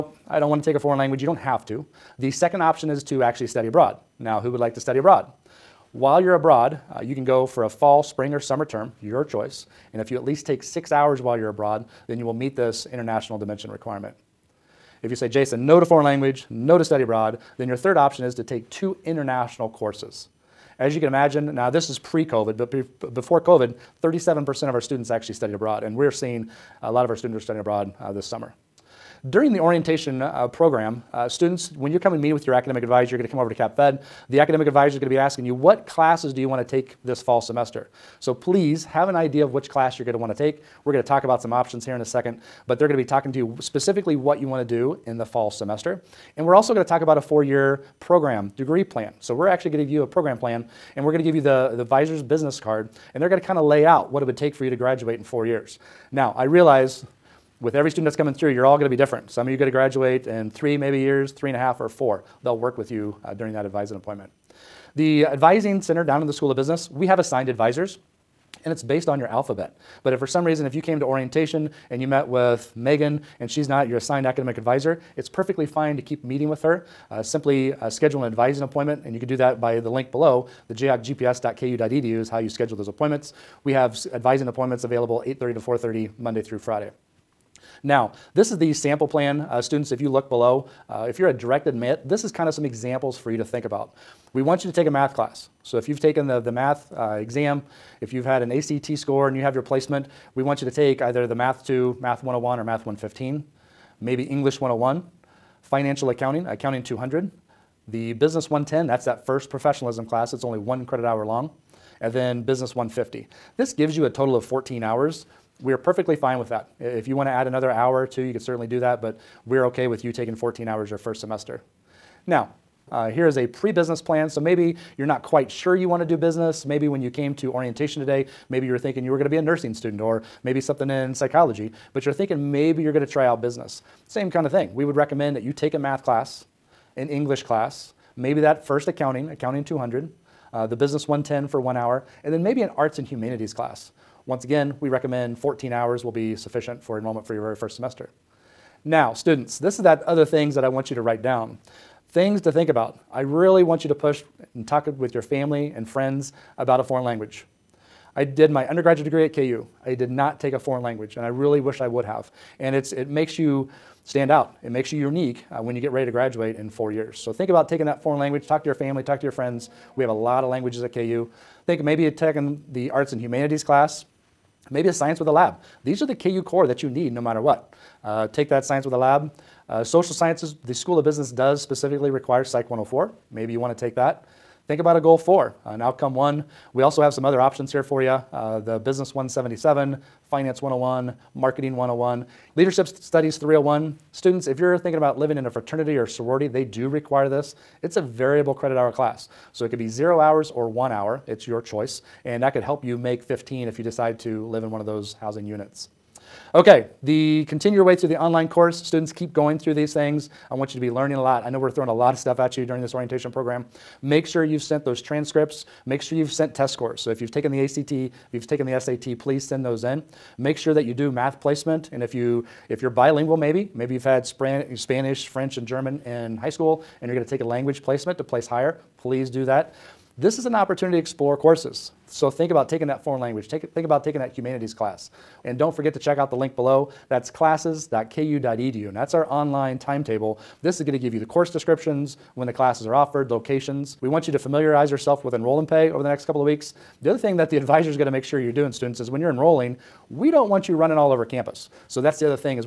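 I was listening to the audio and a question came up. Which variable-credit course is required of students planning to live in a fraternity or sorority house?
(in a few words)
Leadership Studies 301.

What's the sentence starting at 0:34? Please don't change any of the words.
The academic advisor is going to be asking you, what classes do you want to take this fall semester?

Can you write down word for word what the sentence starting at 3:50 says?
This is an opportunity to explore courses.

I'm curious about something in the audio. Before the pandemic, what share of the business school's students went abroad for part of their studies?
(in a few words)
37%.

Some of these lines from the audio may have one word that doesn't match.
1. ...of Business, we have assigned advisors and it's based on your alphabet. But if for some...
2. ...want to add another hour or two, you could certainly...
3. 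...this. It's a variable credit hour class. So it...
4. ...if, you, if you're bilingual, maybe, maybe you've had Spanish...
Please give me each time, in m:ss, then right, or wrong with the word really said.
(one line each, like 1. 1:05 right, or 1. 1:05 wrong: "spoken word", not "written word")
1. 1:06 right
2. 1:57 right
3. 3:17 right
4. 3:42 right.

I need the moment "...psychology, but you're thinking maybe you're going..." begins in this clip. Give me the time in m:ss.
2:11.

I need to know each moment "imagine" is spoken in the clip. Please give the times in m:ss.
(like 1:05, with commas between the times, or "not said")
0:21.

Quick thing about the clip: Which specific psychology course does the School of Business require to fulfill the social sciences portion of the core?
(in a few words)
Psych 104.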